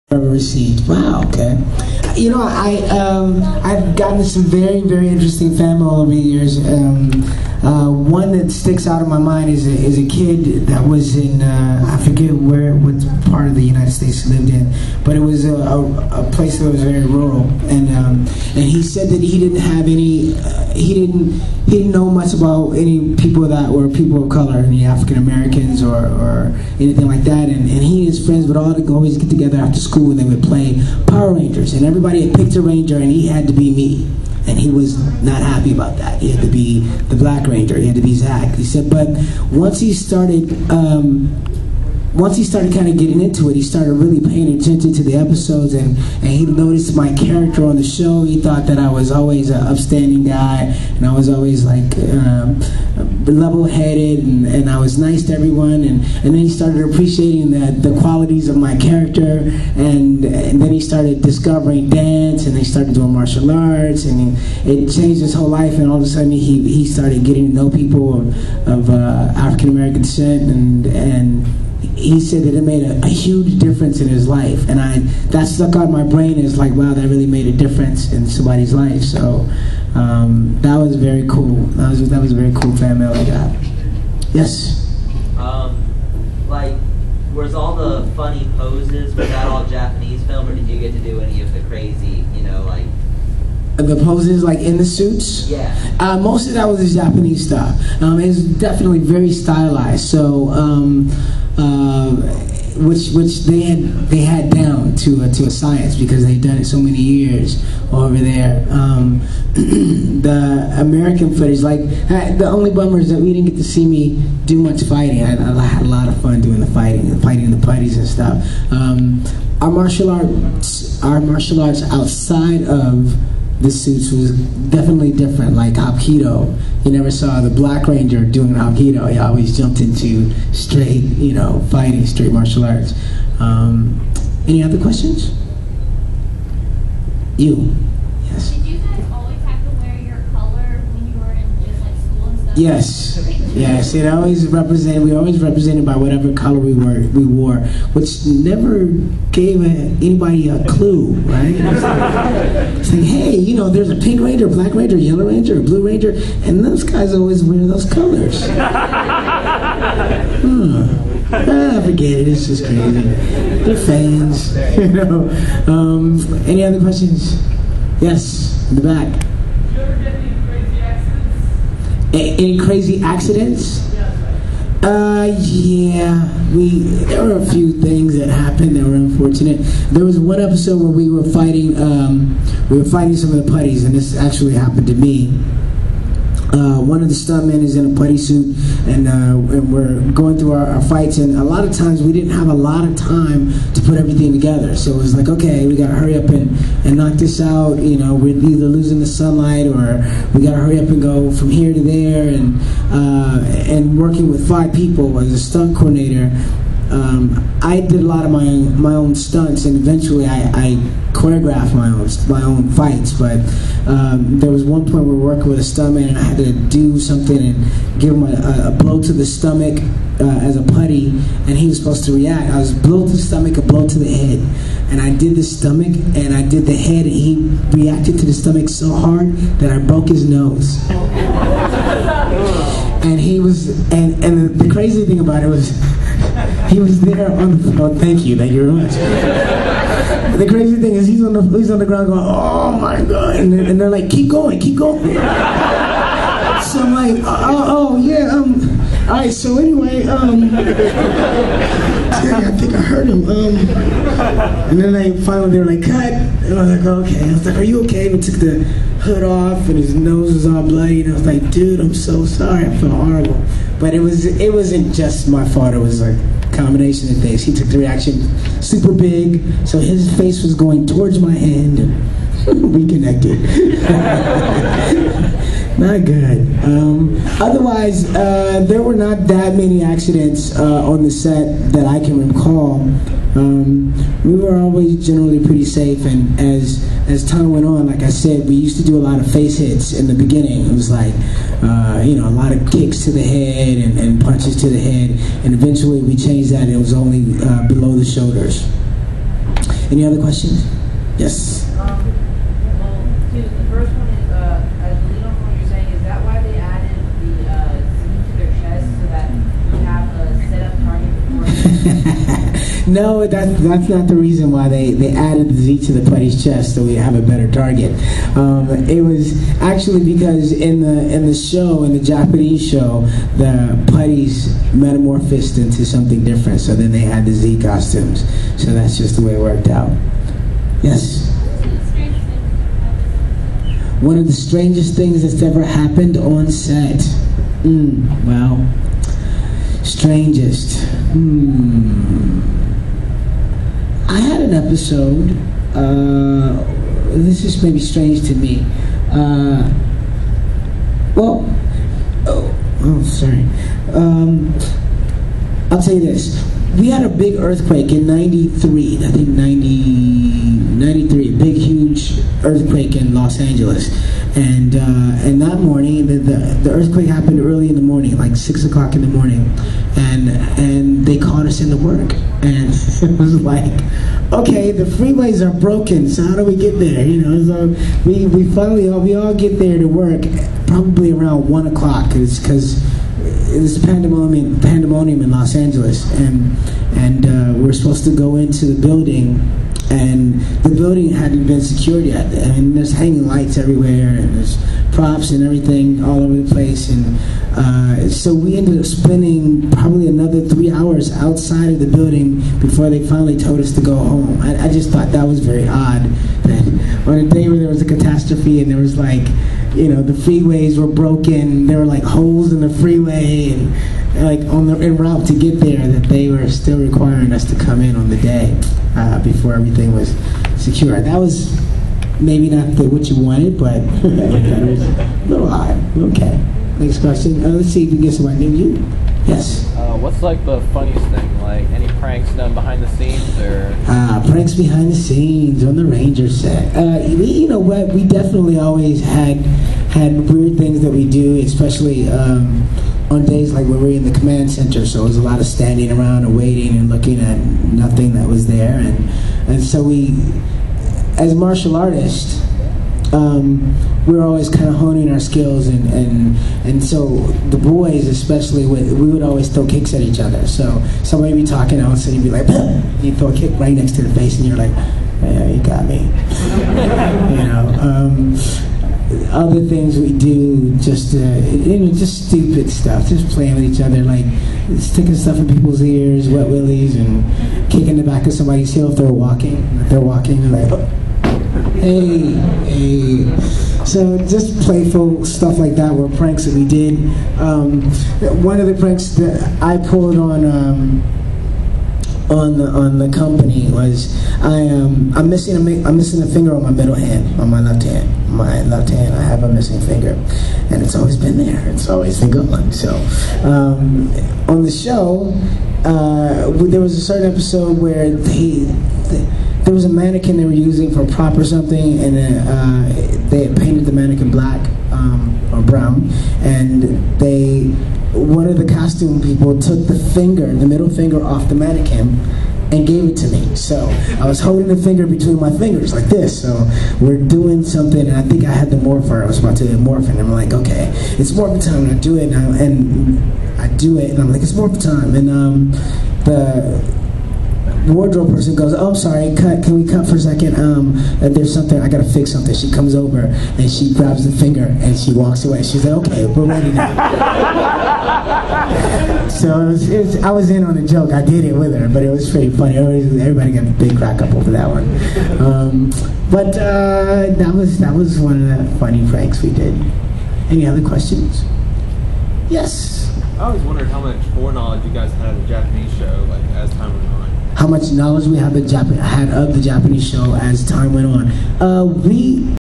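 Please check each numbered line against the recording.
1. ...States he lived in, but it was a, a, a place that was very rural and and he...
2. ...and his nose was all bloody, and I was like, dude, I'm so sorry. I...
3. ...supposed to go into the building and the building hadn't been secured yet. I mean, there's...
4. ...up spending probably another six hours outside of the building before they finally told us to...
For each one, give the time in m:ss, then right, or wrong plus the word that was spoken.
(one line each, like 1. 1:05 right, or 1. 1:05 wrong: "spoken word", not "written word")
1. 0:13 right
2. 4:19 right
3. 6:27 right
4. 6:38 wrong: "three", not "six".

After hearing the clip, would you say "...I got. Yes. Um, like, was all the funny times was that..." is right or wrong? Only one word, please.
wrong.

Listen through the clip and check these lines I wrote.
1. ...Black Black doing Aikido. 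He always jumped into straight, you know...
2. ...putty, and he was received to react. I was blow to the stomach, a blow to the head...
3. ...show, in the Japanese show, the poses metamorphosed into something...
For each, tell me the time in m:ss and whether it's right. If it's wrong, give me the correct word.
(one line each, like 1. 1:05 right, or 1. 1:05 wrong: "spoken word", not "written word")
1. 2:07 wrong: "Ranger", not "Black"
2. 3:40 wrong: "supposed", not "received"
3. 5:21 wrong: "putties", not "poses".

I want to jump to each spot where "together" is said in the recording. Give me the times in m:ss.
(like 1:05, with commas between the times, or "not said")
0:29, 3:14.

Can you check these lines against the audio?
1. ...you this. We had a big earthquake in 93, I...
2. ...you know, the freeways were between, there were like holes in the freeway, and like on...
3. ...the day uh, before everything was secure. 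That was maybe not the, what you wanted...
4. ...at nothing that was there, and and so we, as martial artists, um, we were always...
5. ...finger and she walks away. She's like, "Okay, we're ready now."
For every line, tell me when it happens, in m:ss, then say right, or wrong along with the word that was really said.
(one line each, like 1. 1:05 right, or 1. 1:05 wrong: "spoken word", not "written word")
1. 5:55 right
2. 6:49 wrong: "broken", not "between"
3. 6:58 right
4. 7:27 right
5. 9:04 right.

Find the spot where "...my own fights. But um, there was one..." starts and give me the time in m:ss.
3:32.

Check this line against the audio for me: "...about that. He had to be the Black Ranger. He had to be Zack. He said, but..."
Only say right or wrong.
right.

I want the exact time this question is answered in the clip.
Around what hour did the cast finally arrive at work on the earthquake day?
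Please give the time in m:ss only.
6:21.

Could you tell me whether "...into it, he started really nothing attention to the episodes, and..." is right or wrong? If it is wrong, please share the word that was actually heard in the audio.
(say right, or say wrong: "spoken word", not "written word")
wrong: "paying", not "nothing".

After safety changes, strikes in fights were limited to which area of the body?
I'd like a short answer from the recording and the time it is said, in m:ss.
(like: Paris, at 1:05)
below the shoulders, at 4:57.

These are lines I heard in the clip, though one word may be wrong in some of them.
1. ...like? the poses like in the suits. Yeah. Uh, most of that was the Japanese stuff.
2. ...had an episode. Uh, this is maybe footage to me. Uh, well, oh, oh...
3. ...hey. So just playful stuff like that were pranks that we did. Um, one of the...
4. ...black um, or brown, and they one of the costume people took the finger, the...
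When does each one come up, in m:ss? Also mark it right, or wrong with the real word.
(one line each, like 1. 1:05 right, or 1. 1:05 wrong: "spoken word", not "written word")
1. 1:32 right
2. 5:44 wrong: "strange", not "footage"
3. 8:02 right
4. 8:34 right.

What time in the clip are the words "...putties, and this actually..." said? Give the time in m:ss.
3:03.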